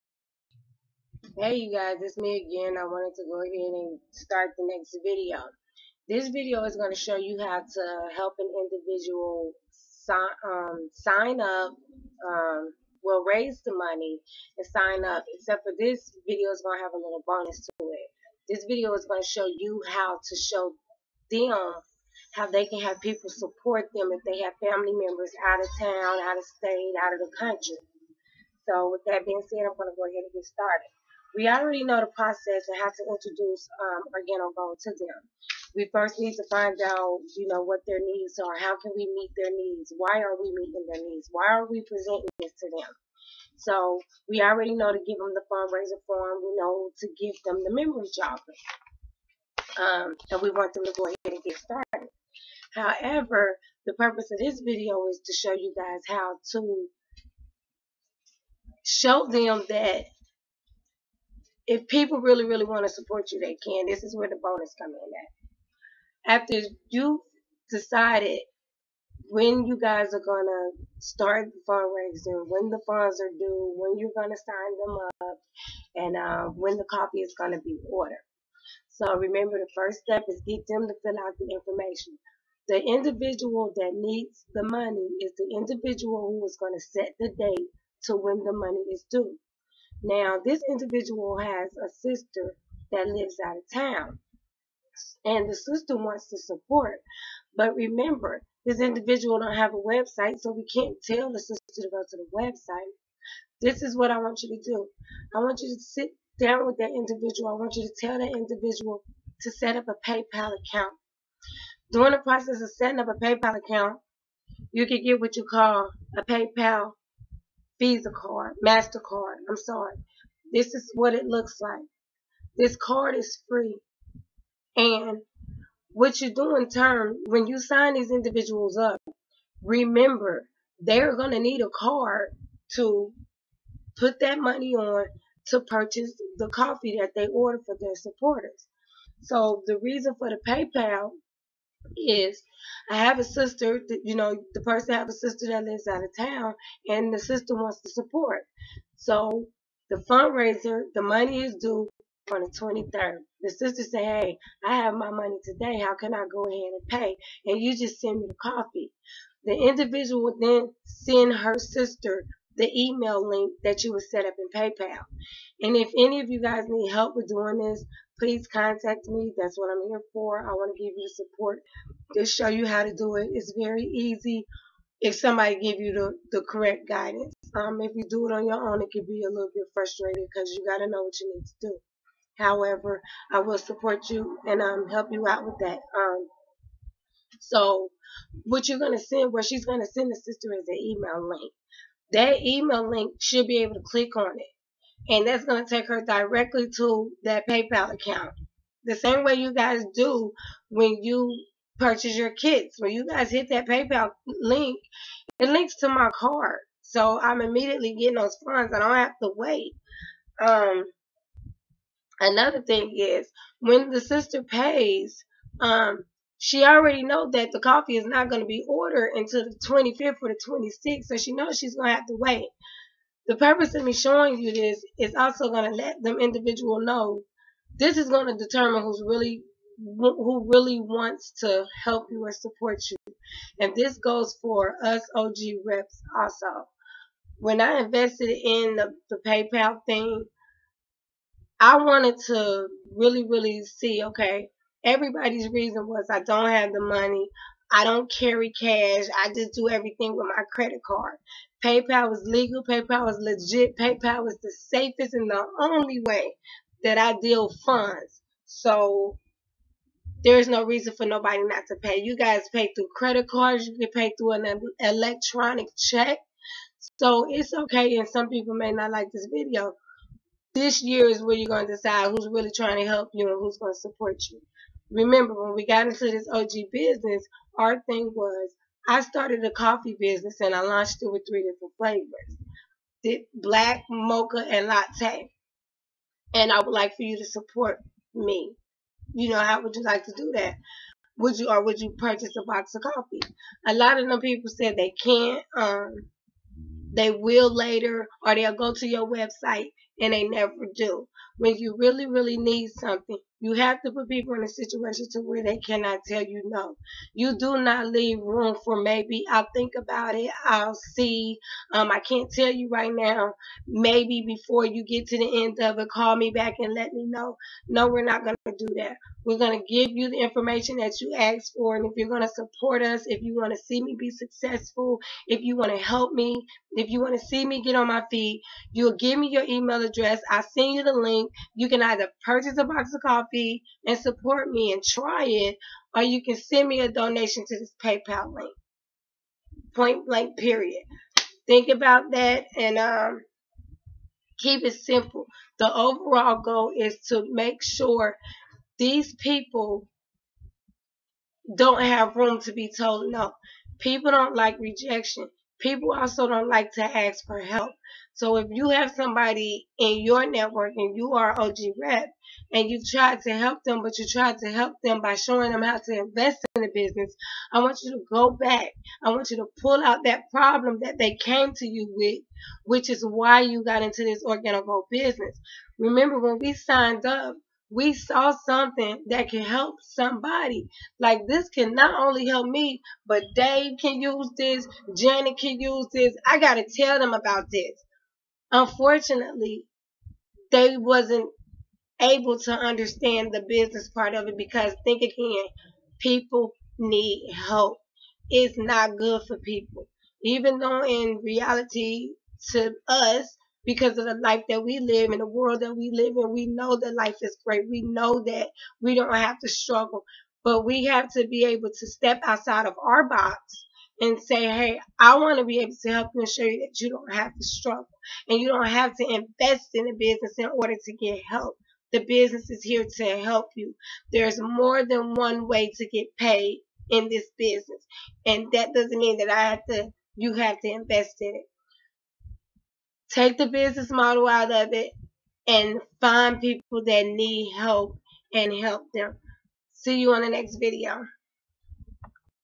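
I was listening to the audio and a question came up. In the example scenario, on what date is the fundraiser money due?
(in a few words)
23rd.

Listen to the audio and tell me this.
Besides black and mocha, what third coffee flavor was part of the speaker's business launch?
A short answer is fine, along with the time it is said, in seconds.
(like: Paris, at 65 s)
Latte, at 284 s.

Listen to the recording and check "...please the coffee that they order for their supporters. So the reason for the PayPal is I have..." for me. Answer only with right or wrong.
wrong.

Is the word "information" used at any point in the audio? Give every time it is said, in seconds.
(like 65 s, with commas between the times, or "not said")
81 s, 320 s.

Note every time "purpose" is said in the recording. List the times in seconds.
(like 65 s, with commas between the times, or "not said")
53 s, 223 s.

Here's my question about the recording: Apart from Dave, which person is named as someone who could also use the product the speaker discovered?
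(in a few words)
Janet.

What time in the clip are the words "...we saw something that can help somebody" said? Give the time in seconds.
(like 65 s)
377 s.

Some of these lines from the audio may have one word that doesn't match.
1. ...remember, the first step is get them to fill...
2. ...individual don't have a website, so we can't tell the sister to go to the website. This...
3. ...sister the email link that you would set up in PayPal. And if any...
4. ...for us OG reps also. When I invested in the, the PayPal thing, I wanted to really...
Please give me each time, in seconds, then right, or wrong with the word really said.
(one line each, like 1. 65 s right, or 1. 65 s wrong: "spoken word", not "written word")
1. 79 s right
2. 98 s right
3. 161 s right
4. 234 s right.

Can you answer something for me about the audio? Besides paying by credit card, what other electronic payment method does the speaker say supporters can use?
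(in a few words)
Electronic check.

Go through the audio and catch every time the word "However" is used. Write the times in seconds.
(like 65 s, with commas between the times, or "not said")
52 s, 182 s.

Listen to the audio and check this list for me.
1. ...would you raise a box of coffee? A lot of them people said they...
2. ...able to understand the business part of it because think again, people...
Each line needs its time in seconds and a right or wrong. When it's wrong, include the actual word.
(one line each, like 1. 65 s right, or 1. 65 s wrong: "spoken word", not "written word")
1. 291 s wrong: "purchase", not "raise"
2. 392 s right.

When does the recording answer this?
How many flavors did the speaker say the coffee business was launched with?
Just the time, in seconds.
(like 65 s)
281 s.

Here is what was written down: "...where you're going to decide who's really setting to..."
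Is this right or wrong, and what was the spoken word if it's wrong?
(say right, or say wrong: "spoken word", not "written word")
wrong: "trying", not "setting".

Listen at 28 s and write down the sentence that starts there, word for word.
So with that being said, I'm going to go ahead and get started.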